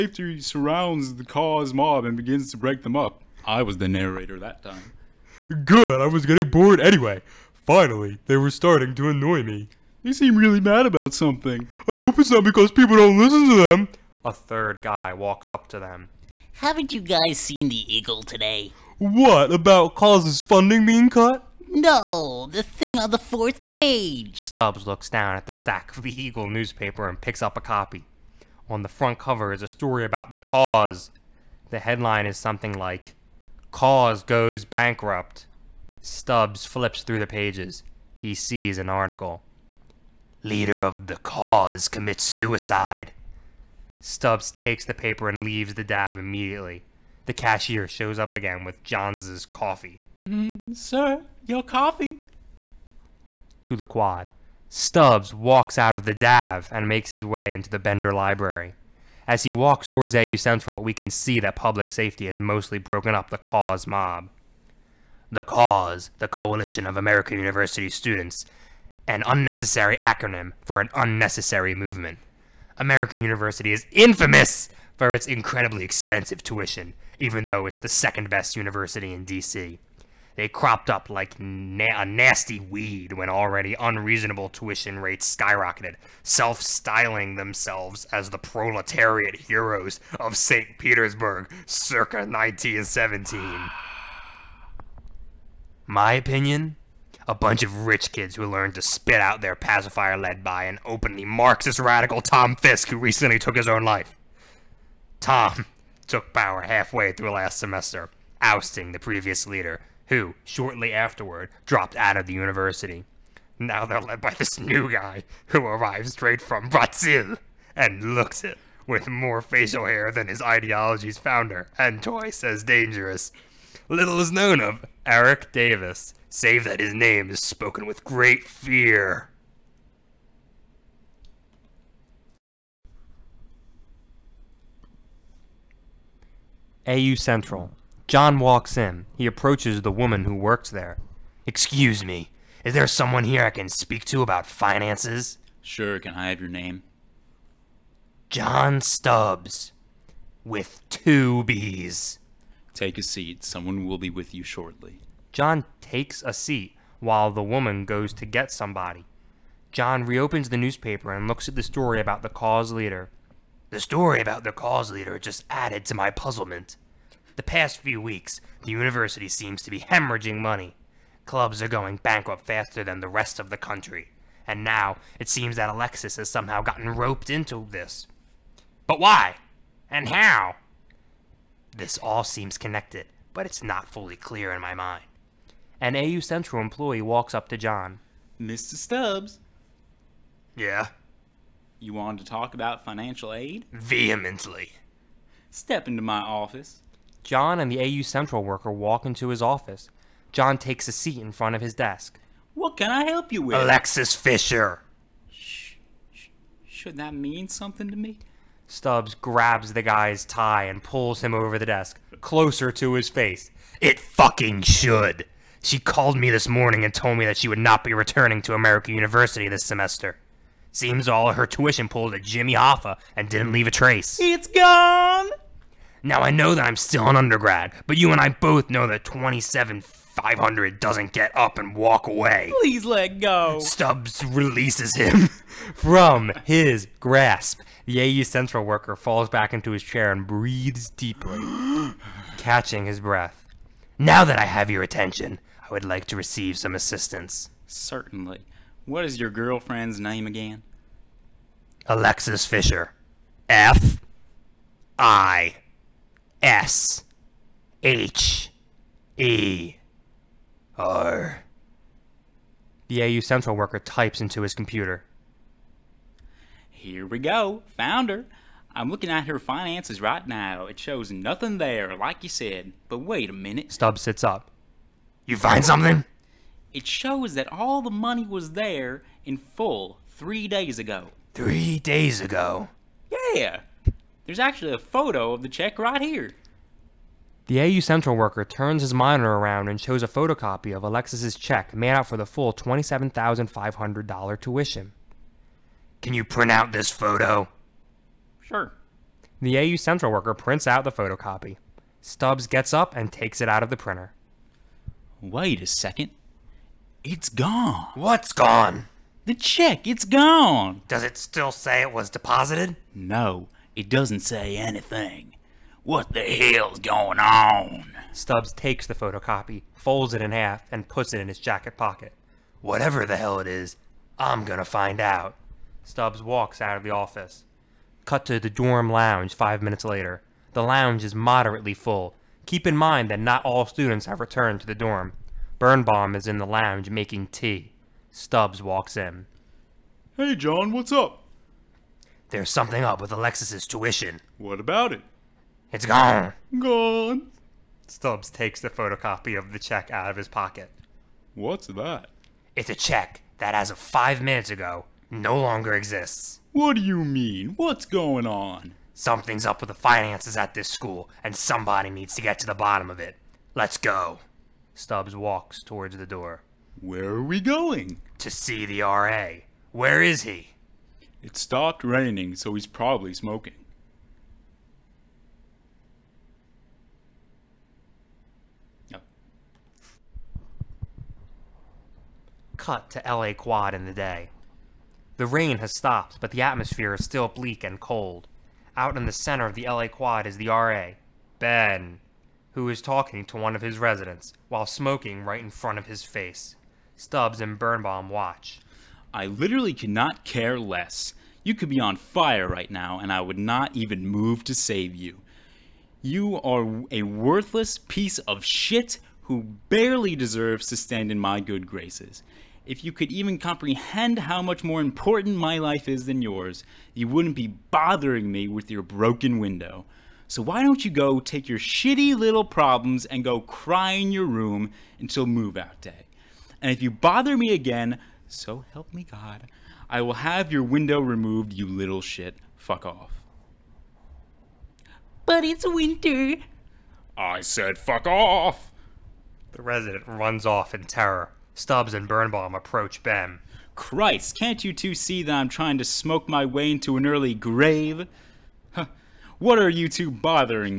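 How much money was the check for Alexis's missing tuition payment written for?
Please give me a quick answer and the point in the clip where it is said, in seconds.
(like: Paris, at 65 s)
$27,500, at 292 s.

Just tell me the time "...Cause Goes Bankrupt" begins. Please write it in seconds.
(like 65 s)
33 s.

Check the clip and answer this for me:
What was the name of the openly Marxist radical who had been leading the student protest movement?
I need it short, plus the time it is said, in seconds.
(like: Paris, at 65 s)
Tom Fisk, at 102 s.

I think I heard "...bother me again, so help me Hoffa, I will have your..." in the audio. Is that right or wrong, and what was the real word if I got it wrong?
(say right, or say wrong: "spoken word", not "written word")
wrong: "God", not "Hoffa".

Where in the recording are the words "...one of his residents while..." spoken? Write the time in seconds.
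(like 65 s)
393 s.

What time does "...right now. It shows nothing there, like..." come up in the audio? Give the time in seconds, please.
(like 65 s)
270 s.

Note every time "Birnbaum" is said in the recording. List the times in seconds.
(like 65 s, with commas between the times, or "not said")
335 s, 397 s, 442 s.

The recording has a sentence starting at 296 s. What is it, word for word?
Can you print out this photo?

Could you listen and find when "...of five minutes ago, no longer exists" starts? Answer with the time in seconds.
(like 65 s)
353 s.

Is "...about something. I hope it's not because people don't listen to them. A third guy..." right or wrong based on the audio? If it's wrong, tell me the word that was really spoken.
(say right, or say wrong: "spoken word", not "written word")
right.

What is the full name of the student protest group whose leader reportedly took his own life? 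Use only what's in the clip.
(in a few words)
Coalition of American University Students.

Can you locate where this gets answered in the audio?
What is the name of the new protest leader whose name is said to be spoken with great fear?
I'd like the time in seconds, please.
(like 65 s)
125 s.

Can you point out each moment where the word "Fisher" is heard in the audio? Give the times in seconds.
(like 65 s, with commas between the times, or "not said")
204 s, 252 s.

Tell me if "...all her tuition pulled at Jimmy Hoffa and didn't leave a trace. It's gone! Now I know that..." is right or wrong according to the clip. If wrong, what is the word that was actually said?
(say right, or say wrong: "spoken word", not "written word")
right.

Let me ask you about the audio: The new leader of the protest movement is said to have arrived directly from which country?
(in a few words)
Brazil.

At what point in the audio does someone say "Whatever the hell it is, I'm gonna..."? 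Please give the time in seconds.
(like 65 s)
322 s.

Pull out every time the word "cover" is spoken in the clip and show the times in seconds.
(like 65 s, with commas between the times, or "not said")
29 s.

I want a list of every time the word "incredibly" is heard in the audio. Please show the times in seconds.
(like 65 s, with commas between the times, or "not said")
75 s.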